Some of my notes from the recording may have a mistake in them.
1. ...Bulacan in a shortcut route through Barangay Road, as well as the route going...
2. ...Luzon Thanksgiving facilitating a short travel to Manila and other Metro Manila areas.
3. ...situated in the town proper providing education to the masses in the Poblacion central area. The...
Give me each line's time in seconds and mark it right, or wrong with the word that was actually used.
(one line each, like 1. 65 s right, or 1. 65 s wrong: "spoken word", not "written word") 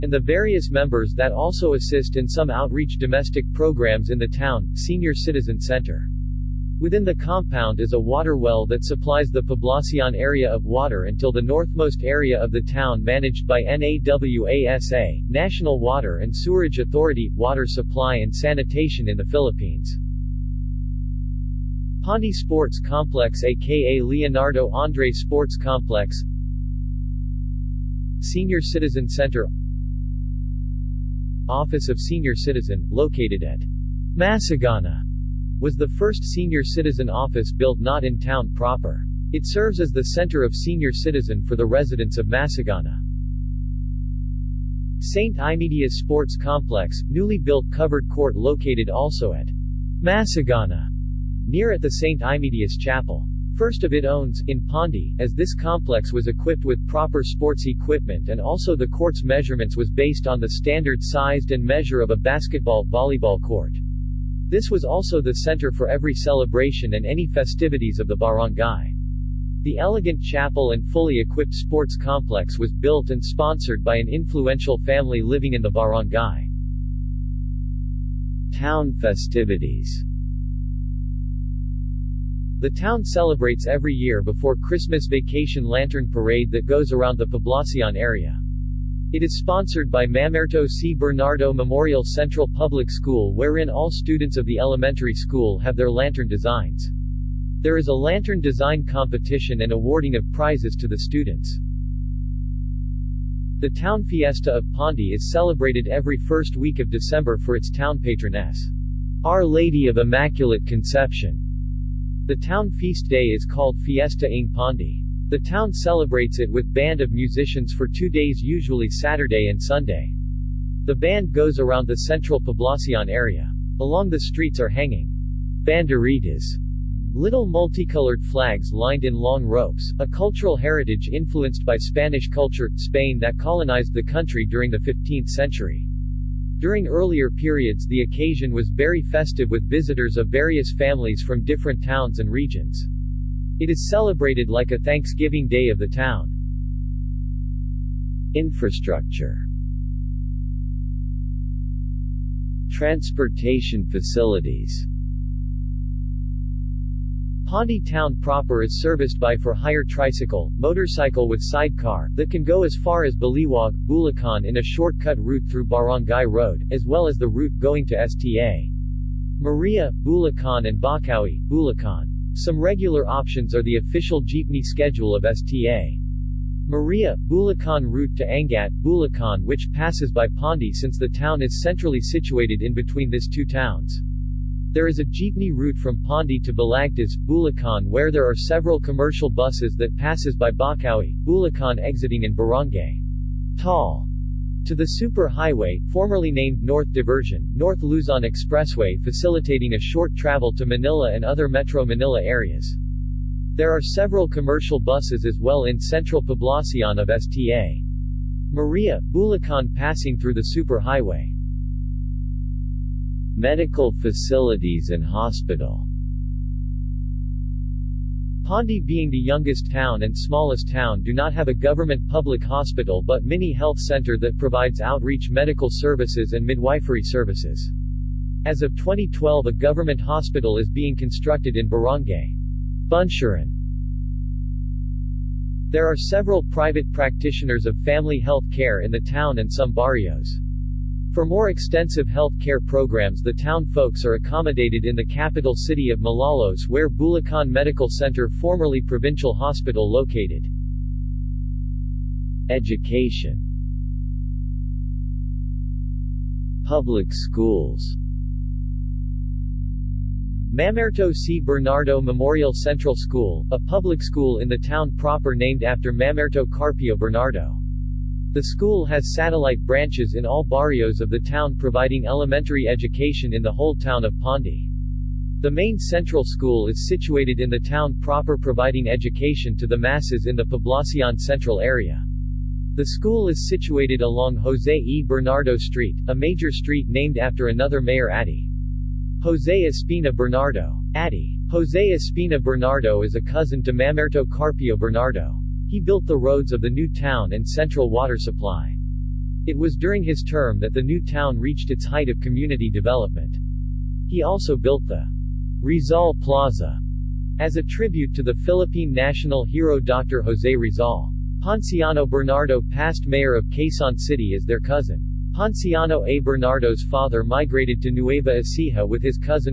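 1. 163 s right
2. 197 s wrong: "Expressway", not "Thanksgiving"
3. 276 s right.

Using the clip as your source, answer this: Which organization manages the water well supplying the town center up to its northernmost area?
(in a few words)
NAWASA.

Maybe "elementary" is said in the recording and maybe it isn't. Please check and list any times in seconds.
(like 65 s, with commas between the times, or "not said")
94 s, 272 s.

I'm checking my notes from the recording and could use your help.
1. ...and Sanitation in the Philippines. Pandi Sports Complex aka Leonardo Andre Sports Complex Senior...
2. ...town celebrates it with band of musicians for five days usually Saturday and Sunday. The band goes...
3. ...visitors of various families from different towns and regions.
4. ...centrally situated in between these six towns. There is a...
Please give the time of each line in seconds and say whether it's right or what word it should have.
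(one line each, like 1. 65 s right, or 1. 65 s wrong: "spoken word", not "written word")
1. 18 s right
2. 115 s wrong: "two", not "five"
3. 139 s right
4. 181 s wrong: "two", not "six".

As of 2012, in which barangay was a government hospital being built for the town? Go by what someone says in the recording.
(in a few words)
Buncheran.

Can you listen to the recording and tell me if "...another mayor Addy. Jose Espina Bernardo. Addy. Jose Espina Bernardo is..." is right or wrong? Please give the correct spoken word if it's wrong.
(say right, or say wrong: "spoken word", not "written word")
right.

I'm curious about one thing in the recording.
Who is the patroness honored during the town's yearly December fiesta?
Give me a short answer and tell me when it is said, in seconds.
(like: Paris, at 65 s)
Our Lady of Immaculate Conception, at 109 s.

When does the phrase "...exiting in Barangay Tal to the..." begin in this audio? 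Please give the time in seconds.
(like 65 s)
191 s.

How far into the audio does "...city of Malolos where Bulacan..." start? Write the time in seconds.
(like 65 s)
245 s.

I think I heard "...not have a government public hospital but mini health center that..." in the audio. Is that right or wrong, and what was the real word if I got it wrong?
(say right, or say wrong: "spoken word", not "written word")
right.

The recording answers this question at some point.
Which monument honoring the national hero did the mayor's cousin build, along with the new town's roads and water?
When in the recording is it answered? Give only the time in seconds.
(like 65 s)
305 s.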